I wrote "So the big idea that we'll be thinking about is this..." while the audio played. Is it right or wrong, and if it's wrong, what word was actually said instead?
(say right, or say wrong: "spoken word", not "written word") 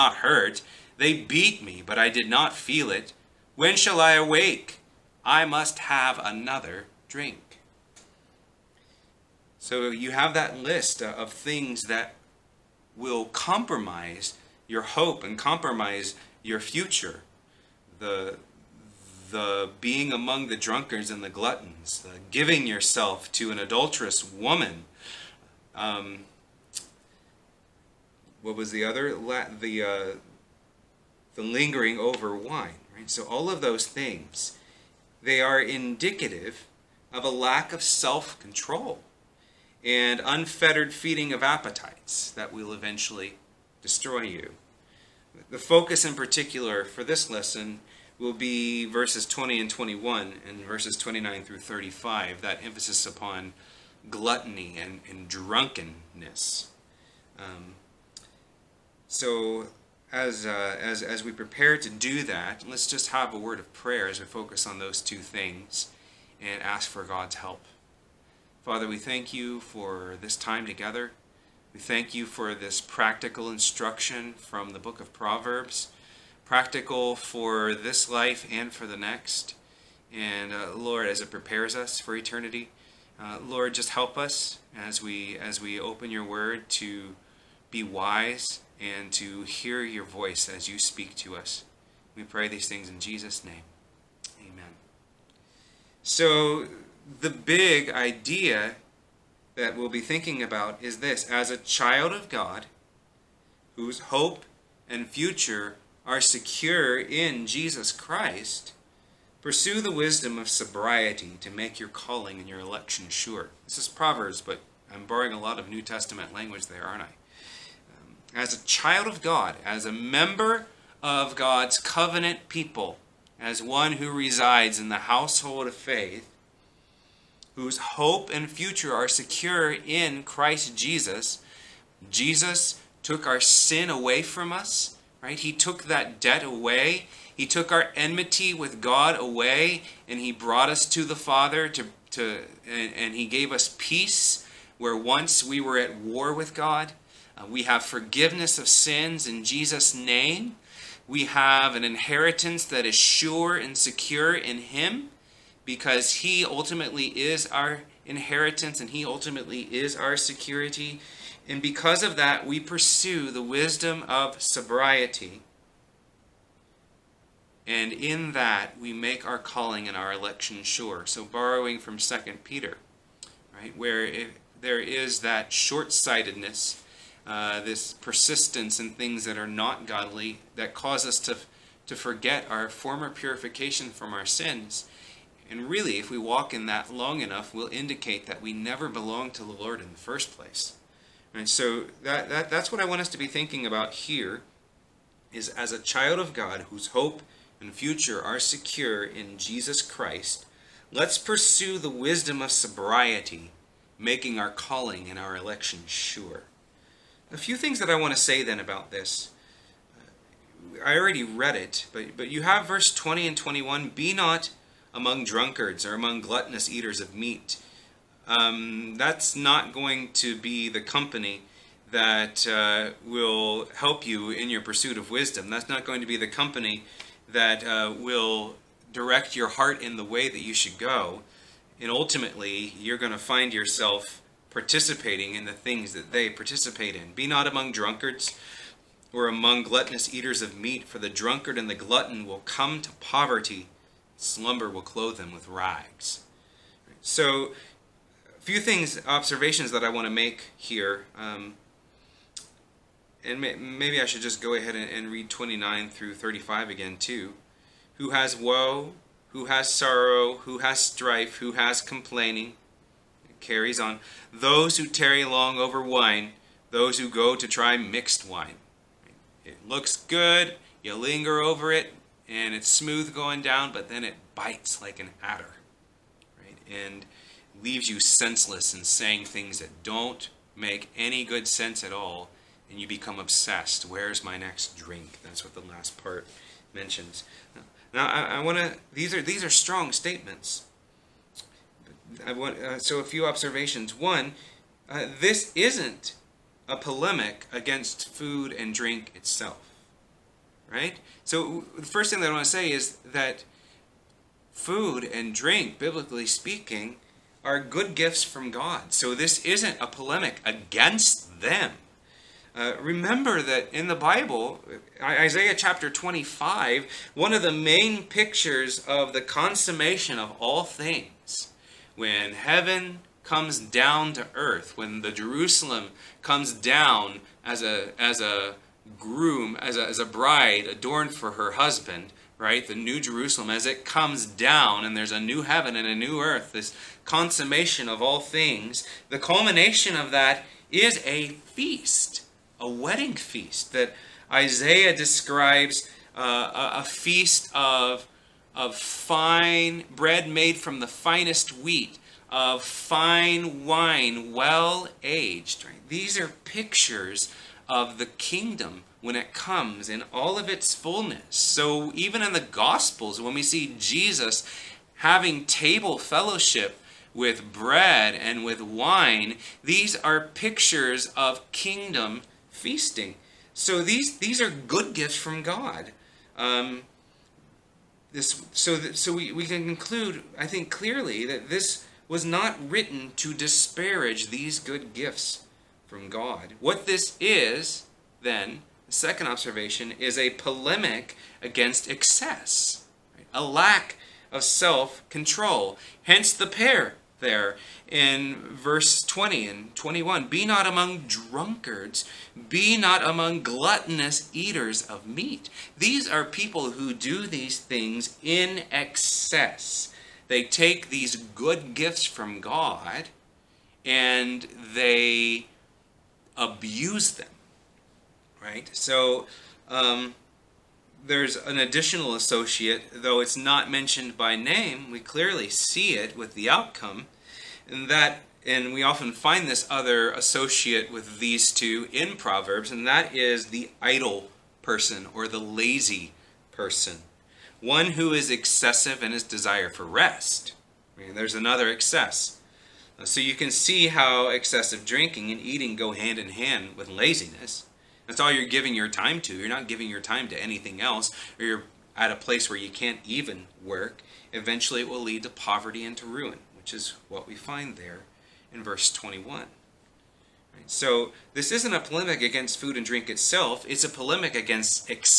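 right.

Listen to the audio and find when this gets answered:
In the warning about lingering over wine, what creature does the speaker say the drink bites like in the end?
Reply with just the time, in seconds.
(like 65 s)
274 s.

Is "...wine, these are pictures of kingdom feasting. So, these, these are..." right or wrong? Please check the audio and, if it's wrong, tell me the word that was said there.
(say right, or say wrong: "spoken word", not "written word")
right.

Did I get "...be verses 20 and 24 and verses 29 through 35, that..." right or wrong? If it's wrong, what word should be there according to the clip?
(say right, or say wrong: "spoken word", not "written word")
wrong: "21", not "24".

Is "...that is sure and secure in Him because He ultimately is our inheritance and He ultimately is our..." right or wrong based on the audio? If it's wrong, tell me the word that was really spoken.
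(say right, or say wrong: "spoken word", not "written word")
right.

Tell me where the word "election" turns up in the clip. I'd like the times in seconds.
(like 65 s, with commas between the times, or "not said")
112 s, 170 s, 205 s.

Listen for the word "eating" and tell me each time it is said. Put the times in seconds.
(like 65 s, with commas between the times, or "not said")
445 s.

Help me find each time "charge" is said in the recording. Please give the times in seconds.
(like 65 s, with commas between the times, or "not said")
not said.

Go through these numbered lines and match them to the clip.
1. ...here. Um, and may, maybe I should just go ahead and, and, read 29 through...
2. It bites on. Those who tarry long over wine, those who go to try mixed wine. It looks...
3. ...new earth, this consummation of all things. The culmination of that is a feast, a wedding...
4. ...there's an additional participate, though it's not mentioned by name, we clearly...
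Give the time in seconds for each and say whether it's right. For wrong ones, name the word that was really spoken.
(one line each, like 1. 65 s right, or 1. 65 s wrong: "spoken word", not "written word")
1. 250 s right
2. 263 s wrong: "carries", not "bites"
3. 335 s right
4. 421 s wrong: "associate", not "participate".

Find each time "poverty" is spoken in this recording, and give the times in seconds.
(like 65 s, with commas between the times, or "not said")
242 s, 455 s.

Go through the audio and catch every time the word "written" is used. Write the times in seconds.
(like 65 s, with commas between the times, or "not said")
382 s.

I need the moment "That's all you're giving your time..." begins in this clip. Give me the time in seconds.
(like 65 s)
448 s.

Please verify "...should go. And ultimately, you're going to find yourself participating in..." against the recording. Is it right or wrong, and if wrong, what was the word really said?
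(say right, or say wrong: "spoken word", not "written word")
right.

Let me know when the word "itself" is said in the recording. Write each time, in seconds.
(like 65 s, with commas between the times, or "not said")
299 s, 463 s.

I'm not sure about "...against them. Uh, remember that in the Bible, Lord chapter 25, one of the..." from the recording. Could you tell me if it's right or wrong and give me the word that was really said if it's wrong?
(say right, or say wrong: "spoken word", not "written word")
wrong: "Isaiah", not "Lord".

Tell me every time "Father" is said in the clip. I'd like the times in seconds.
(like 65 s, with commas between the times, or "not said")
68 s, 141 s.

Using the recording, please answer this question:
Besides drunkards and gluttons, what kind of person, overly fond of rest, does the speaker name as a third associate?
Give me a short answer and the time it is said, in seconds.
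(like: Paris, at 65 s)
The idle person, at 433 s.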